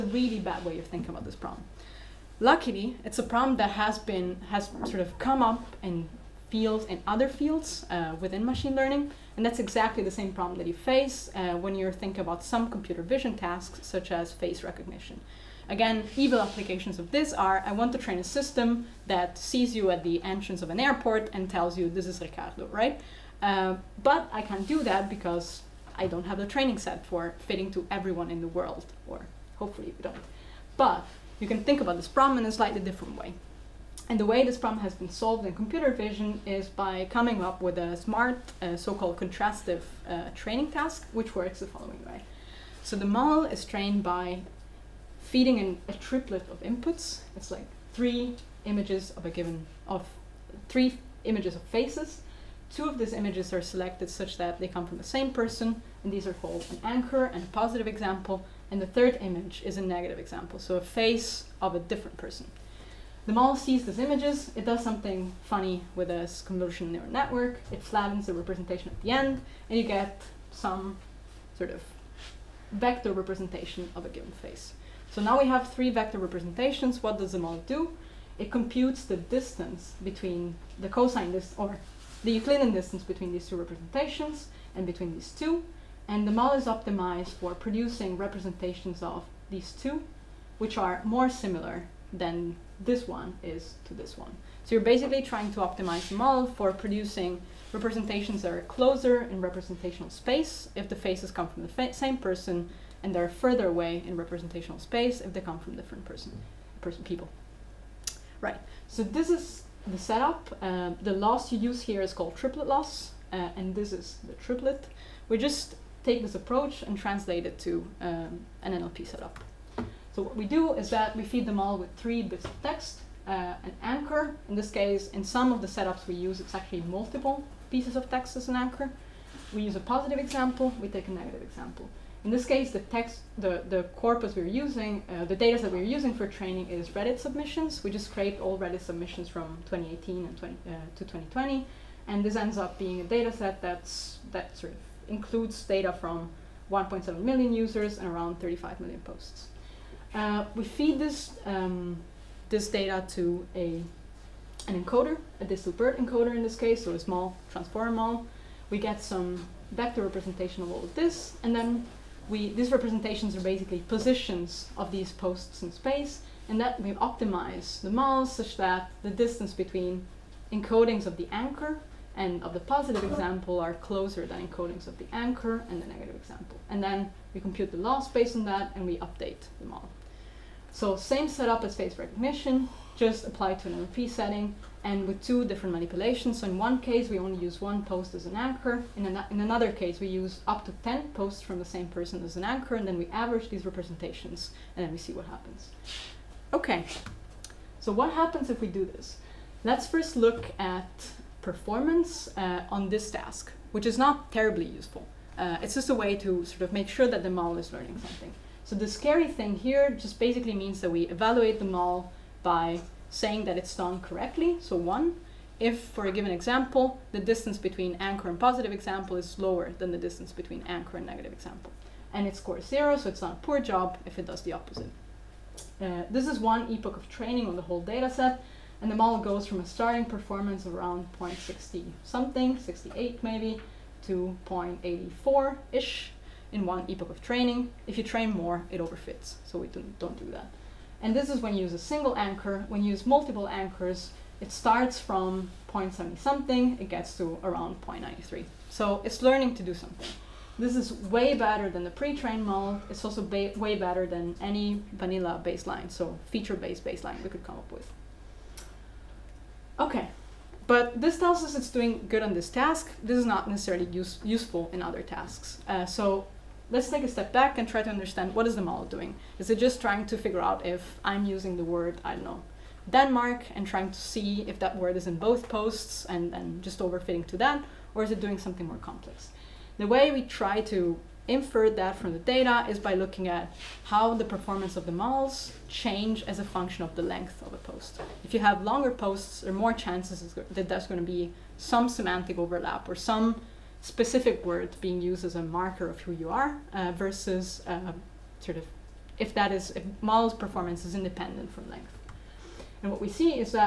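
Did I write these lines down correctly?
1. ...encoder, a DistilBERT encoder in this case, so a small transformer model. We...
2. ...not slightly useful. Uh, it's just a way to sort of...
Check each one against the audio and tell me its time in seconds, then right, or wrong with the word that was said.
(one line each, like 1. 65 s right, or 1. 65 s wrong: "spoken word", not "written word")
1. 154 s right
2. 203 s wrong: "terribly", not "slightly".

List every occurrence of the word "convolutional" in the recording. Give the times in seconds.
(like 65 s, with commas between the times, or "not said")
66 s.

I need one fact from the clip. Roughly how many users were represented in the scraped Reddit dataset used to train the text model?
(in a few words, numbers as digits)
1.7 million.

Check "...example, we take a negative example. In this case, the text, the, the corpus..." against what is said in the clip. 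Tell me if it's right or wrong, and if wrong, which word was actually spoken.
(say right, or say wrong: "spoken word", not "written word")
right.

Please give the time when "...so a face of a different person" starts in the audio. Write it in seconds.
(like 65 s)
60 s.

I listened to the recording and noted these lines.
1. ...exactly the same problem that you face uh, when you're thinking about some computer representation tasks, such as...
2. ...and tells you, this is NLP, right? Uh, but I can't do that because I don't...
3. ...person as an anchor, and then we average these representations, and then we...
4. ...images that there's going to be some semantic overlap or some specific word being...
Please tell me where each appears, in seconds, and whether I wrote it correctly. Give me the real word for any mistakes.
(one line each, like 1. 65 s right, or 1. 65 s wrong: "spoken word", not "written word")
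1. 9 s wrong: "vision", not "representation"
2. 21 s wrong: "Riccardo", not "NLP"
3. 191 s right
4. 289 s wrong: "chances", not "images".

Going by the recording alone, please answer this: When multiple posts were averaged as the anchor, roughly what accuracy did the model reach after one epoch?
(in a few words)
0.93.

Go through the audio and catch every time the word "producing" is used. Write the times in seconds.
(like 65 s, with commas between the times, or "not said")
87 s, 96 s.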